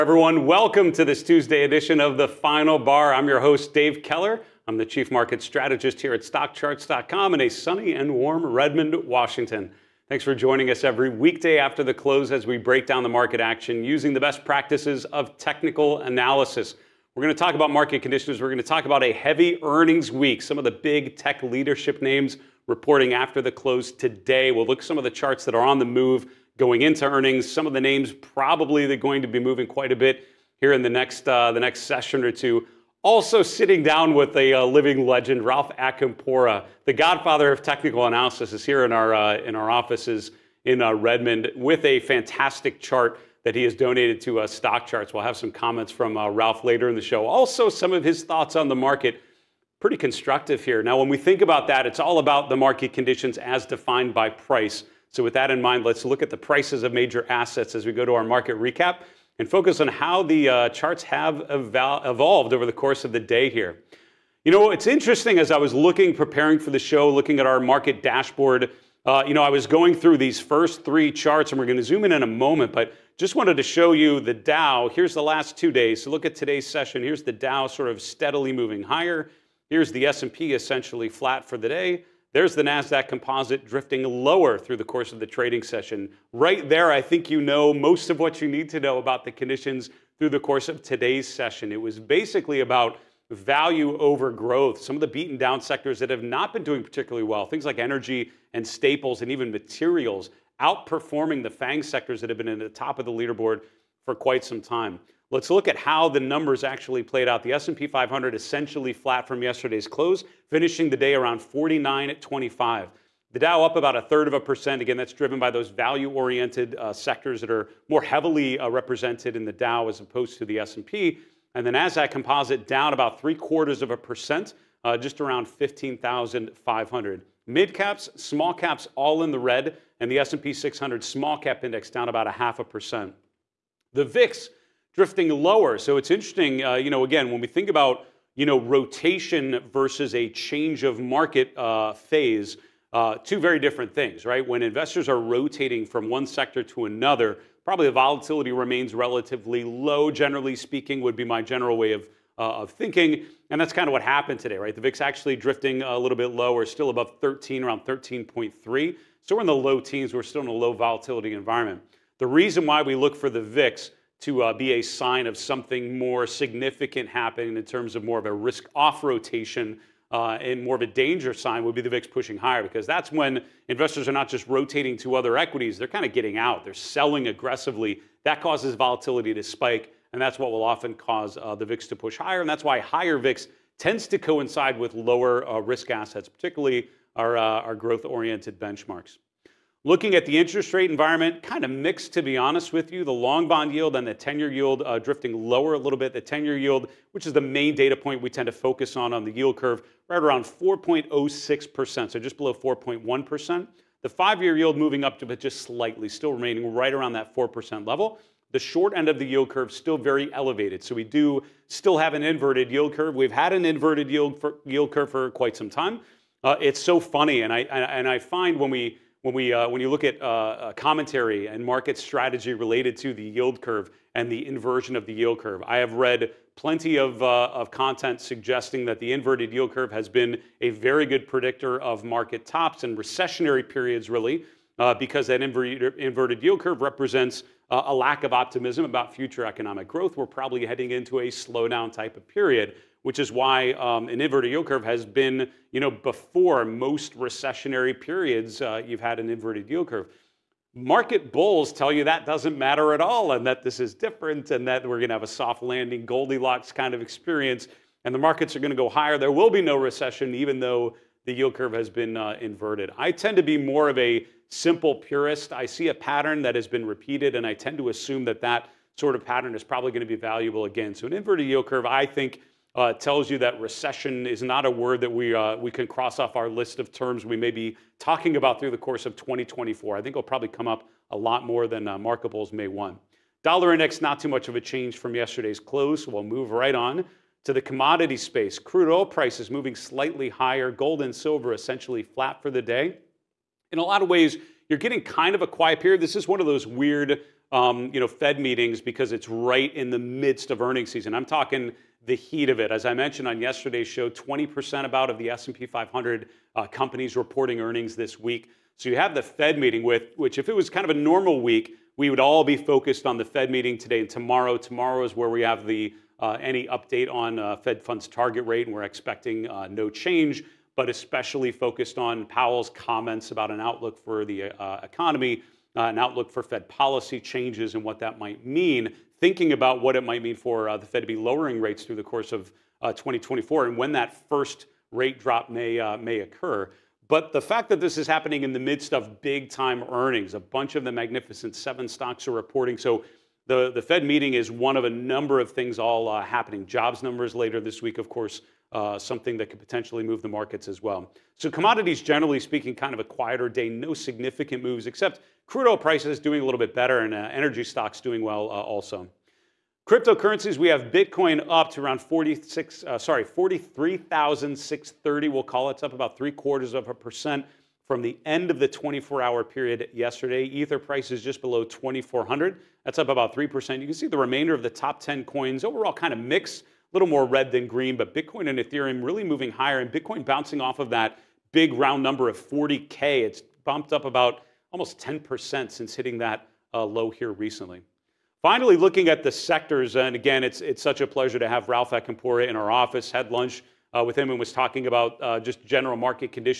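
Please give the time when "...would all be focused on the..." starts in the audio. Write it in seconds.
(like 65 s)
312 s.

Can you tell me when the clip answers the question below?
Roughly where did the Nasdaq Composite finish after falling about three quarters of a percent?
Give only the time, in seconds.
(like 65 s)
125 s.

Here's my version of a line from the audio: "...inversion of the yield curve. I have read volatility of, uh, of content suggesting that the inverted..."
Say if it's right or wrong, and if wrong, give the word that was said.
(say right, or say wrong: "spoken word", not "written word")
wrong: "plenty", not "volatility".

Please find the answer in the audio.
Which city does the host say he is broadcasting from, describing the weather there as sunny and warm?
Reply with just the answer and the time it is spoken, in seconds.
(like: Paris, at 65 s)
Redmond, Washington, at 8 s.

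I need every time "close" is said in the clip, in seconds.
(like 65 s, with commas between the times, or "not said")
11 s, 23 s, 109 s, 285 s.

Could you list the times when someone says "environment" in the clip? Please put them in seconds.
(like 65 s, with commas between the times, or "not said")
161 s, 190 s.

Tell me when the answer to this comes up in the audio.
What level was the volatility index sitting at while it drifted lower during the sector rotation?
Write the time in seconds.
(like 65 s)
157 s.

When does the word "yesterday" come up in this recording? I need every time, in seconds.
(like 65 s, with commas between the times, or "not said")
109 s, 285 s, 303 s, 369 s.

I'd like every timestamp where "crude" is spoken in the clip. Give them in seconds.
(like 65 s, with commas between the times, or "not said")
288 s, 355 s.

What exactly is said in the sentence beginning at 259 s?
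There will be no recession, even though the yield curve has been uh, inverted.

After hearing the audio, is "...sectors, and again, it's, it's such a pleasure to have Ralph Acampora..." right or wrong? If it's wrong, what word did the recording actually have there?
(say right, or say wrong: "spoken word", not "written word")
right.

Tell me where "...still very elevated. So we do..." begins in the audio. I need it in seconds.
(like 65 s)
209 s.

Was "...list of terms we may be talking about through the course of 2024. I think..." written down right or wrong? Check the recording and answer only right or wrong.
right.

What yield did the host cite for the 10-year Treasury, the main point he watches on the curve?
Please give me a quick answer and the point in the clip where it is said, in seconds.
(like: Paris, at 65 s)
4.06%, at 200 s.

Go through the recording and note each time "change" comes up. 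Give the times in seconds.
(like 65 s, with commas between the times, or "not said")
140 s, 284 s, 319 s, 327 s.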